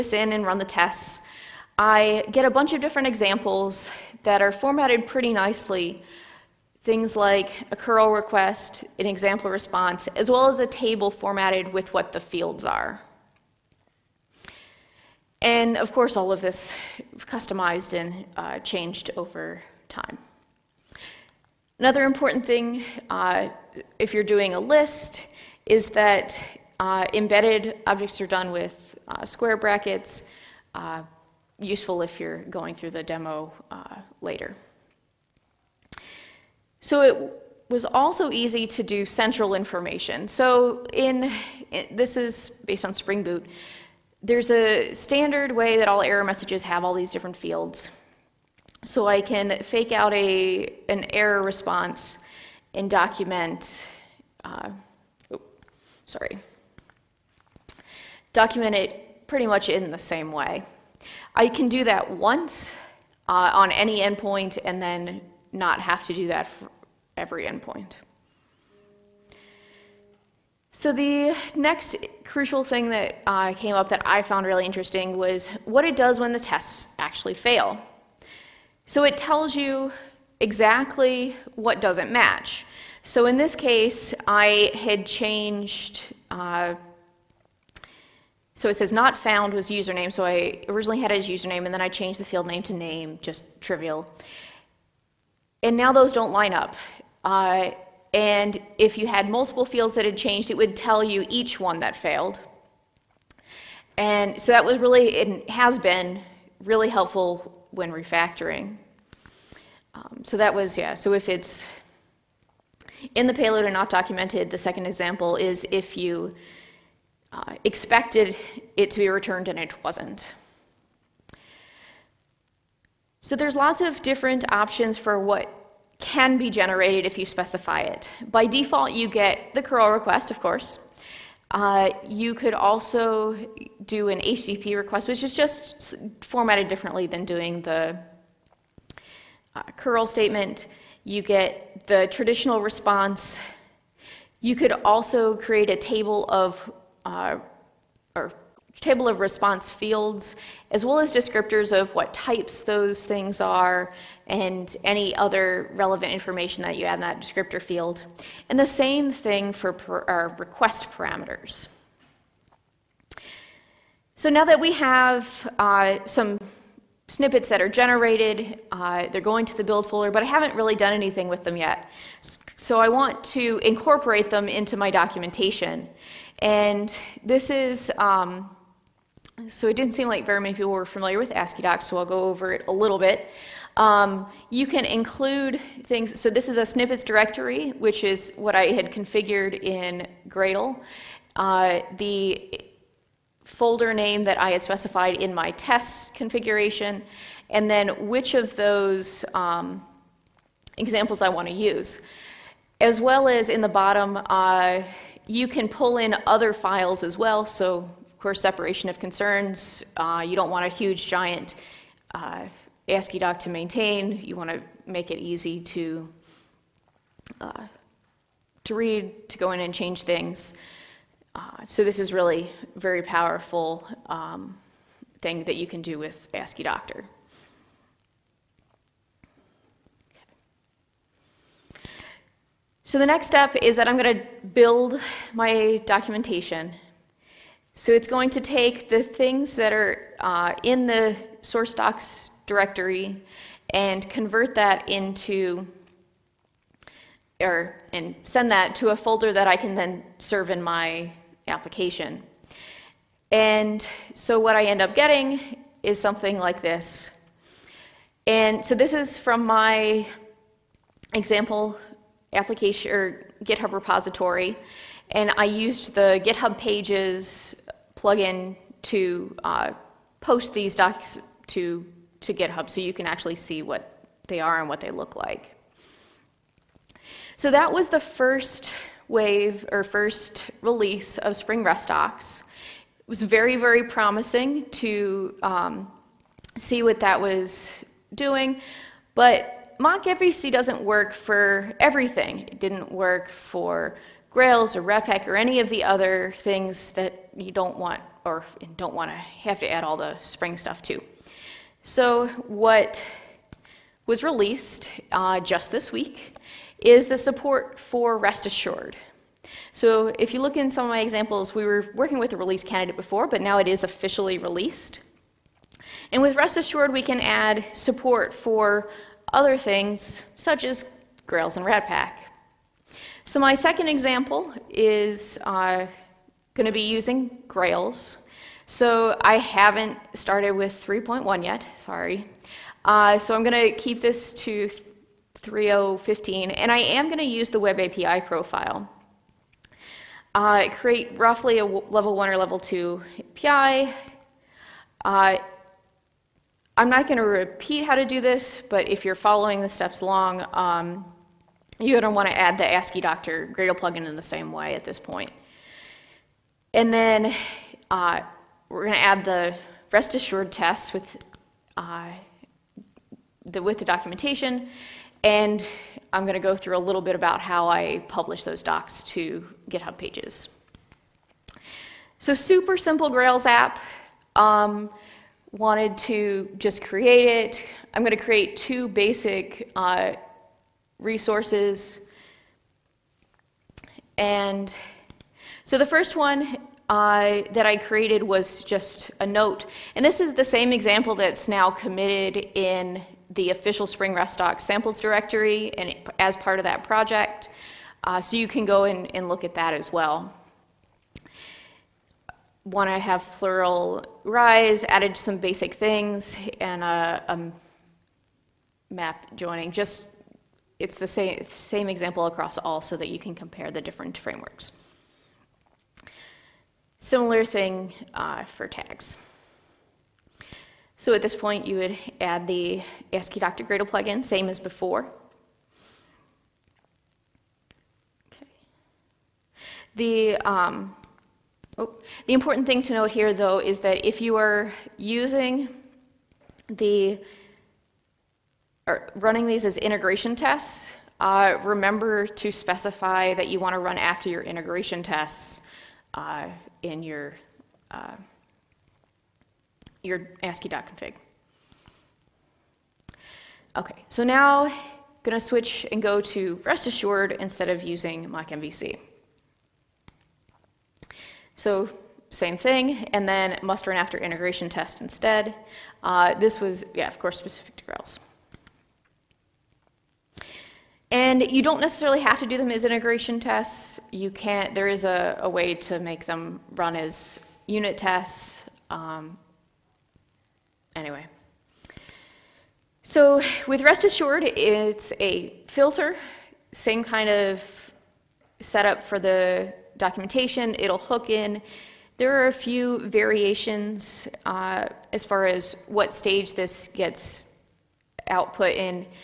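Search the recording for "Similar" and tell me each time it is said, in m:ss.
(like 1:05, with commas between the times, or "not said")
6:56.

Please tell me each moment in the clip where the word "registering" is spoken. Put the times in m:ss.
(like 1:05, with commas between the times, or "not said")
not said.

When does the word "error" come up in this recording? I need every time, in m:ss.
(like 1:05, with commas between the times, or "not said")
0:46, 0:51.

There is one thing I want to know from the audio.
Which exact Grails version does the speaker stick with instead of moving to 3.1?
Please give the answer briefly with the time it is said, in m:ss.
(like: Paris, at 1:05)
3.0.15, at 5:35.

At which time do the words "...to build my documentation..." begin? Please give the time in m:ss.
3:54.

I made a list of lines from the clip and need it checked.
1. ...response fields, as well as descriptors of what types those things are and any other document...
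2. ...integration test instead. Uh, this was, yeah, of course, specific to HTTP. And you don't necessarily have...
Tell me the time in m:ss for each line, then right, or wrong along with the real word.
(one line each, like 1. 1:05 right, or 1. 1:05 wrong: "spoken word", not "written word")
1. 2:29 wrong: "relevant", not "document"
2. 7:44 wrong: "Grails", not "HTTP".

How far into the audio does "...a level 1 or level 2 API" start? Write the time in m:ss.
5:41.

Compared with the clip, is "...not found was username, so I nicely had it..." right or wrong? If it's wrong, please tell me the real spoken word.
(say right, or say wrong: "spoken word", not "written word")
wrong: "originally", not "nicely".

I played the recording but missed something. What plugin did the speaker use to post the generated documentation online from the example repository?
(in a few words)
GitHub Pages plugin.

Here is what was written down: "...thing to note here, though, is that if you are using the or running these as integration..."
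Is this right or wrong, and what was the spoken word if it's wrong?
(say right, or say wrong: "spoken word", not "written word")
right.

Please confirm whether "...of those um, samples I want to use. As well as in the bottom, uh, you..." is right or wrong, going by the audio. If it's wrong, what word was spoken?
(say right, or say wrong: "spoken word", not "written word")
wrong: "examples", not "samples".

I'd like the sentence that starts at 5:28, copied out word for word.
So I haven't started with 3.1 yet, sorry.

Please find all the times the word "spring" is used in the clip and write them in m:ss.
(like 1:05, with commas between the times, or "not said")
0:42, 4:41, 5:00, 6:33.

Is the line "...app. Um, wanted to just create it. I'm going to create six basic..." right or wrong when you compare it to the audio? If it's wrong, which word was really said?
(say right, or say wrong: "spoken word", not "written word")
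wrong: "two", not "six".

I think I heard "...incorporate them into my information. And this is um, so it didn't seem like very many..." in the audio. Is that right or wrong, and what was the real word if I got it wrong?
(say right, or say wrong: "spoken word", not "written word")
wrong: "documentation", not "information".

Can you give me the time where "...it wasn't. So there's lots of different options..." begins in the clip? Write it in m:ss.
1:59.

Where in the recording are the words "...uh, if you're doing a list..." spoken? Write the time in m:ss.
0:23.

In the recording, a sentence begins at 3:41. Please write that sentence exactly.
Uh, so this is really very powerful um, thing that you can do with Asciidoctor.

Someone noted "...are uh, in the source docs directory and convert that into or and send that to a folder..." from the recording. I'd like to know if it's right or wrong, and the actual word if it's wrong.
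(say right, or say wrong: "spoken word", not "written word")
right.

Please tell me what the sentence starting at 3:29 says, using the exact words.
Uh, you don't want a huge, giant uh, AsciiDoc to maintain.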